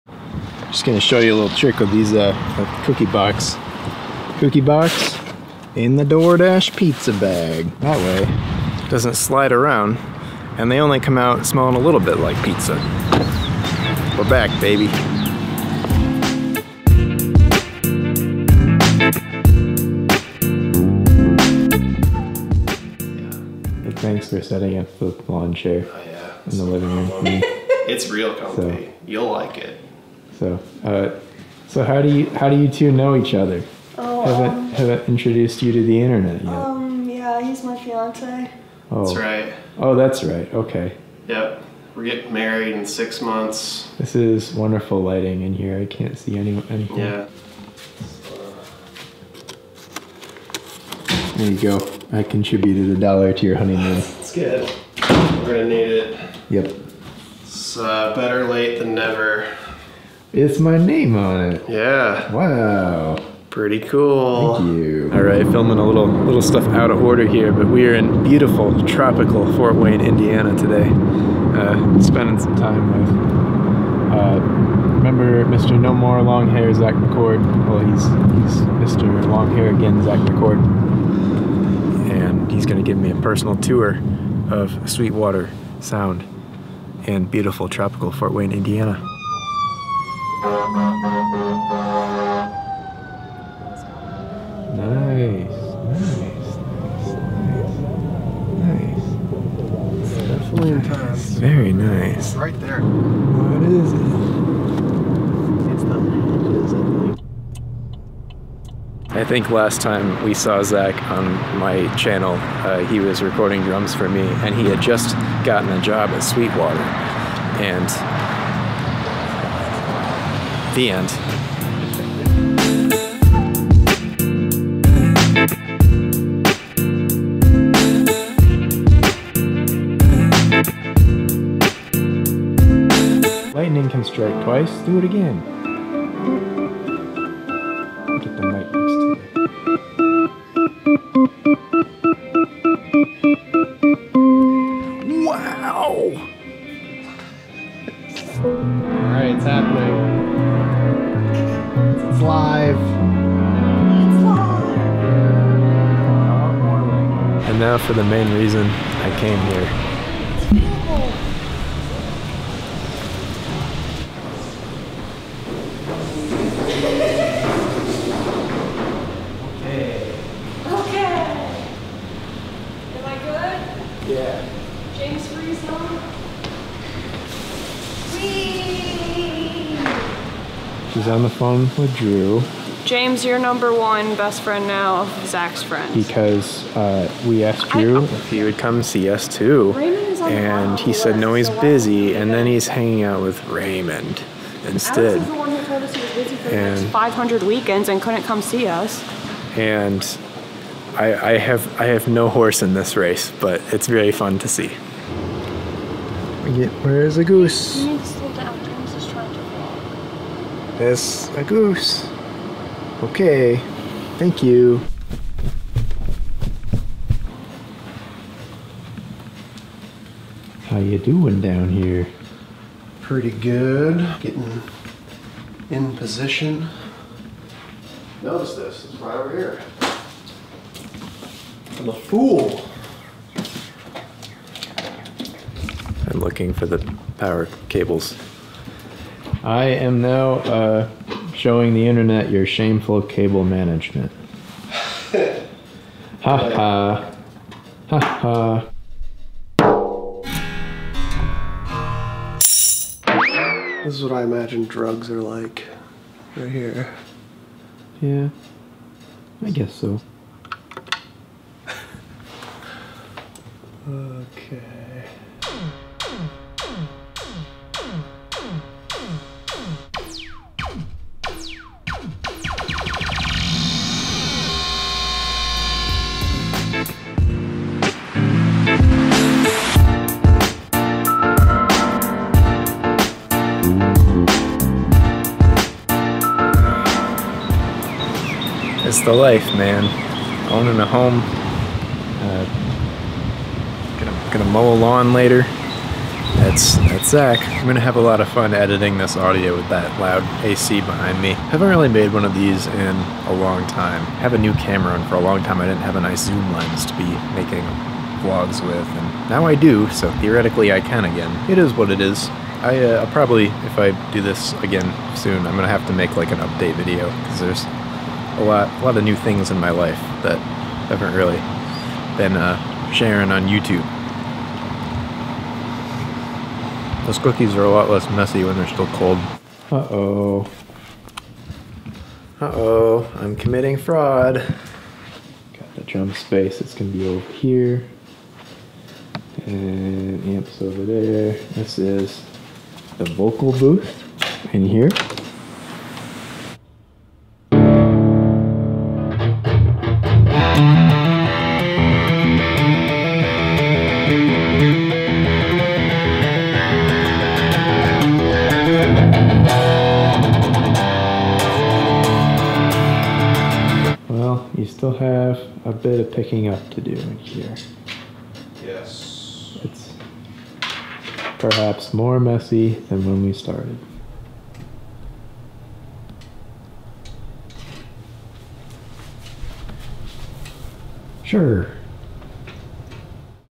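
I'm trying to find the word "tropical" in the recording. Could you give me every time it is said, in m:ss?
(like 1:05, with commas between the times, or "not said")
1:08, 1:27.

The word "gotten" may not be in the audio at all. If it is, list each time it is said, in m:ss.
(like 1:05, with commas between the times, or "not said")
1:55.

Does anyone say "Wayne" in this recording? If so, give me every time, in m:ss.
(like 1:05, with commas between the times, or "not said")
1:09, 1:28.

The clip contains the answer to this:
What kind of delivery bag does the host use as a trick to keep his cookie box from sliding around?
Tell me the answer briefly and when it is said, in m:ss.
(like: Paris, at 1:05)
DoorDash pizza bag, at 0:06.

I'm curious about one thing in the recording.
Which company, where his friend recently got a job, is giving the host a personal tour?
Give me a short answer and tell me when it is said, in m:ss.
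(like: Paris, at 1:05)
Sweetwater Sound, at 1:24.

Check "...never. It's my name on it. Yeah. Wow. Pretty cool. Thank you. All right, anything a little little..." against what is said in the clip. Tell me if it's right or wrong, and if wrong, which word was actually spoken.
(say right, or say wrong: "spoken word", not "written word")
wrong: "filming", not "anything".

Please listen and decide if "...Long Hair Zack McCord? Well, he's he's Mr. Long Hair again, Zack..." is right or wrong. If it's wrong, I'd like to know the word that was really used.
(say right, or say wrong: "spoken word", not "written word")
right.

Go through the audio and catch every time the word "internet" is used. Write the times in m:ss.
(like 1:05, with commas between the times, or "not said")
0:36, 4:01.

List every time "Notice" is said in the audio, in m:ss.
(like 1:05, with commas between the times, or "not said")
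3:48.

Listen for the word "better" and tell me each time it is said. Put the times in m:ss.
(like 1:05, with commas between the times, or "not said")
0:58.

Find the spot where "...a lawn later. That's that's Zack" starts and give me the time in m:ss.
4:54.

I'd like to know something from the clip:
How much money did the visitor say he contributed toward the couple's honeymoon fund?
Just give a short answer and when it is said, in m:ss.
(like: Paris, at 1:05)
A dollar, at 0:52.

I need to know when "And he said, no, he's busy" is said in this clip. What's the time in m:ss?
3:10.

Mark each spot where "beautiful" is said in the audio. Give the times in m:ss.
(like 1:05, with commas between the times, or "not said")
1:08, 1:27.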